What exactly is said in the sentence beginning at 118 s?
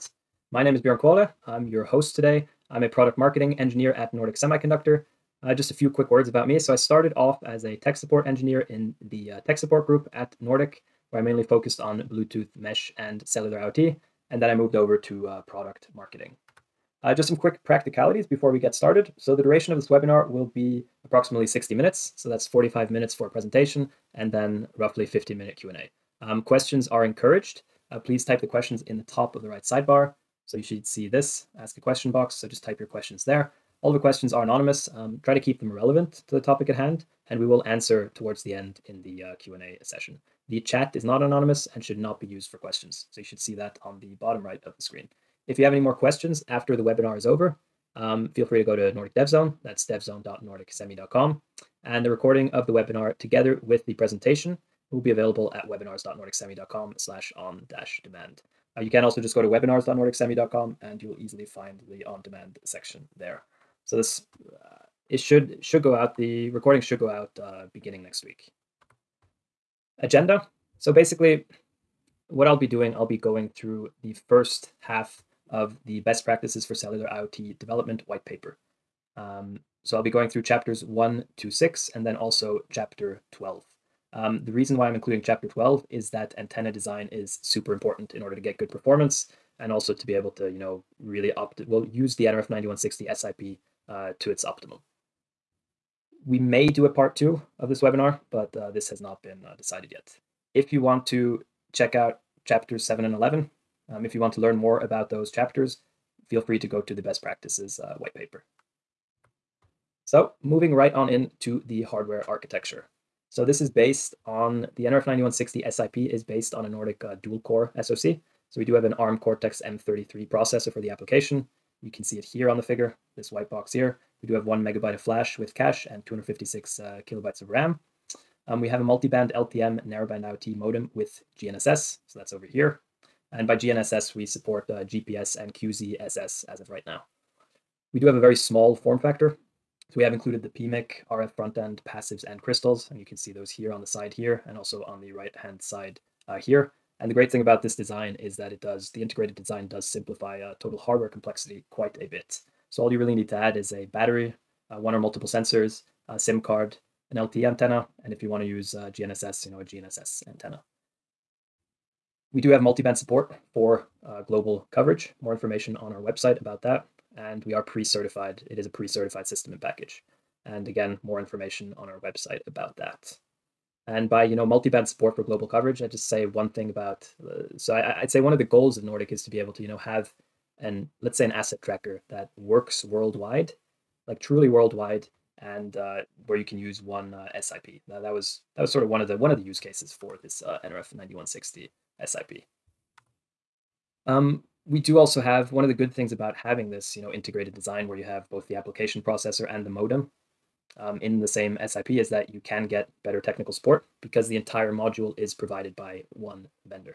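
So we do have an ARM Cortex M33 processor for the application.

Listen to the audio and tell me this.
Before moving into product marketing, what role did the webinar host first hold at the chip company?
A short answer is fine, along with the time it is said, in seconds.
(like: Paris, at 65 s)
Tech support engineer, at 7 s.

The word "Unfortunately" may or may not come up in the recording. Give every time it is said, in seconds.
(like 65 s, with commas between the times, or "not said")
not said.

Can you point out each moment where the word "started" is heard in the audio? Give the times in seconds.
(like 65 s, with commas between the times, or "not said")
6 s, 18 s.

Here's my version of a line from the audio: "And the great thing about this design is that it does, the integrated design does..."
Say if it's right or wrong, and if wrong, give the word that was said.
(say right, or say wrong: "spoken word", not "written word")
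right.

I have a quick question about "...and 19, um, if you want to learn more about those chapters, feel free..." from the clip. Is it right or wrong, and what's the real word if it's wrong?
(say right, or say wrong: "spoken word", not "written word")
wrong: "11", not "19".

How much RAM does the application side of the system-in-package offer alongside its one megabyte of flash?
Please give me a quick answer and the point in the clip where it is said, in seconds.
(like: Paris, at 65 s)
256 kilobytes, at 126 s.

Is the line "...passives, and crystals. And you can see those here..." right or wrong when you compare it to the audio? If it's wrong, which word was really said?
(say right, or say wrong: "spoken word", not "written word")
right.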